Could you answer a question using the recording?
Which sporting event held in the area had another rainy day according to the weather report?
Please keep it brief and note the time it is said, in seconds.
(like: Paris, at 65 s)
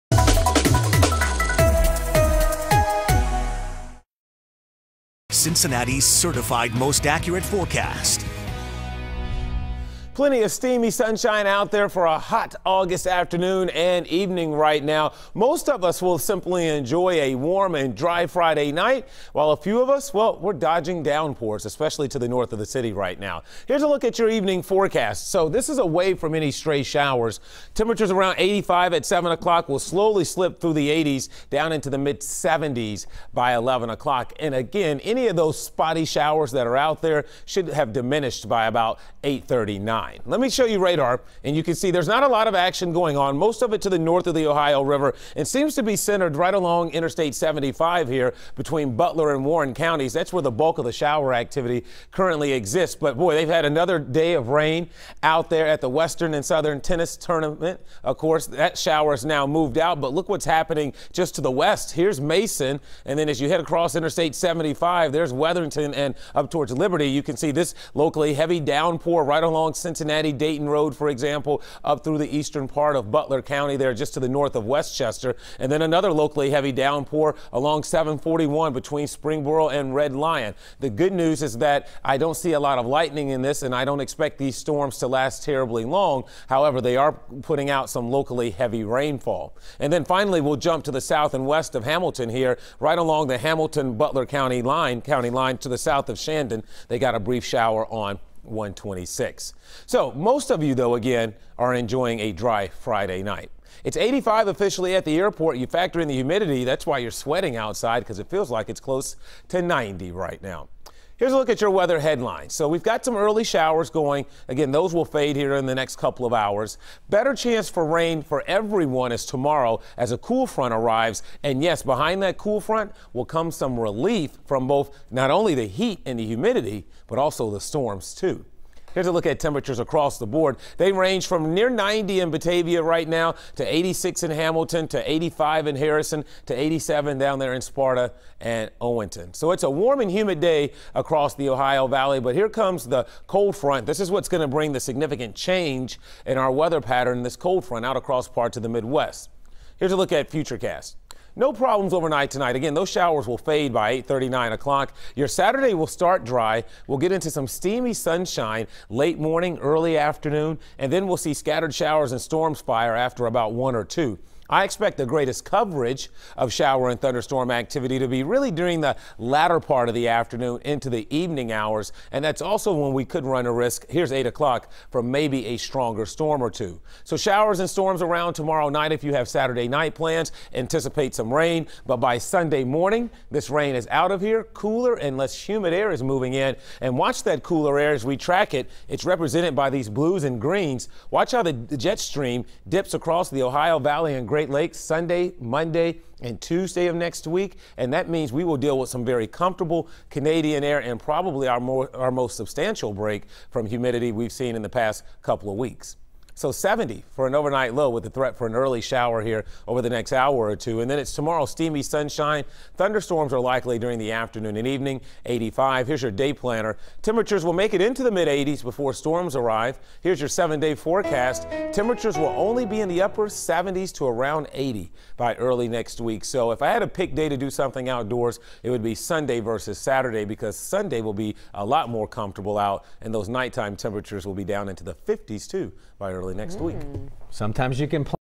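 Western and Southern Tennis Tournament, at 55 s.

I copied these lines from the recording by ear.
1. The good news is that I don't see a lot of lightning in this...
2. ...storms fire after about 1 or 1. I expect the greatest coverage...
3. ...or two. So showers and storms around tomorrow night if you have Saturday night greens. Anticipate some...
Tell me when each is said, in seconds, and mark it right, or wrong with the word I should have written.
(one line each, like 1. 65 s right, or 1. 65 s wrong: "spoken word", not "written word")
1. 80 s right
2. 162 s wrong: "2", not "1"
3. 176 s wrong: "plans", not "greens".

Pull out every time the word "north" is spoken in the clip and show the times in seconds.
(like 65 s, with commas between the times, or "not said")
22 s, 43 s, 74 s.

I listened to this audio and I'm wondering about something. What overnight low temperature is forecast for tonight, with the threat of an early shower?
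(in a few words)
70.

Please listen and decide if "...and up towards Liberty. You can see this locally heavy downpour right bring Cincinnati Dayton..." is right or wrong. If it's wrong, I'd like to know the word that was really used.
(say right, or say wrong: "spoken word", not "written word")
wrong: "along", not "bring".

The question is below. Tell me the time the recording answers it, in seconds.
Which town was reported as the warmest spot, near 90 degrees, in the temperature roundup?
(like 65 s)
132 s.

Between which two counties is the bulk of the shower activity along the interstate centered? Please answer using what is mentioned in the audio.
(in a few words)
Butler and Warren.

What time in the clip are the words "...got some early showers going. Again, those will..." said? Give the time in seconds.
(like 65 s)
112 s.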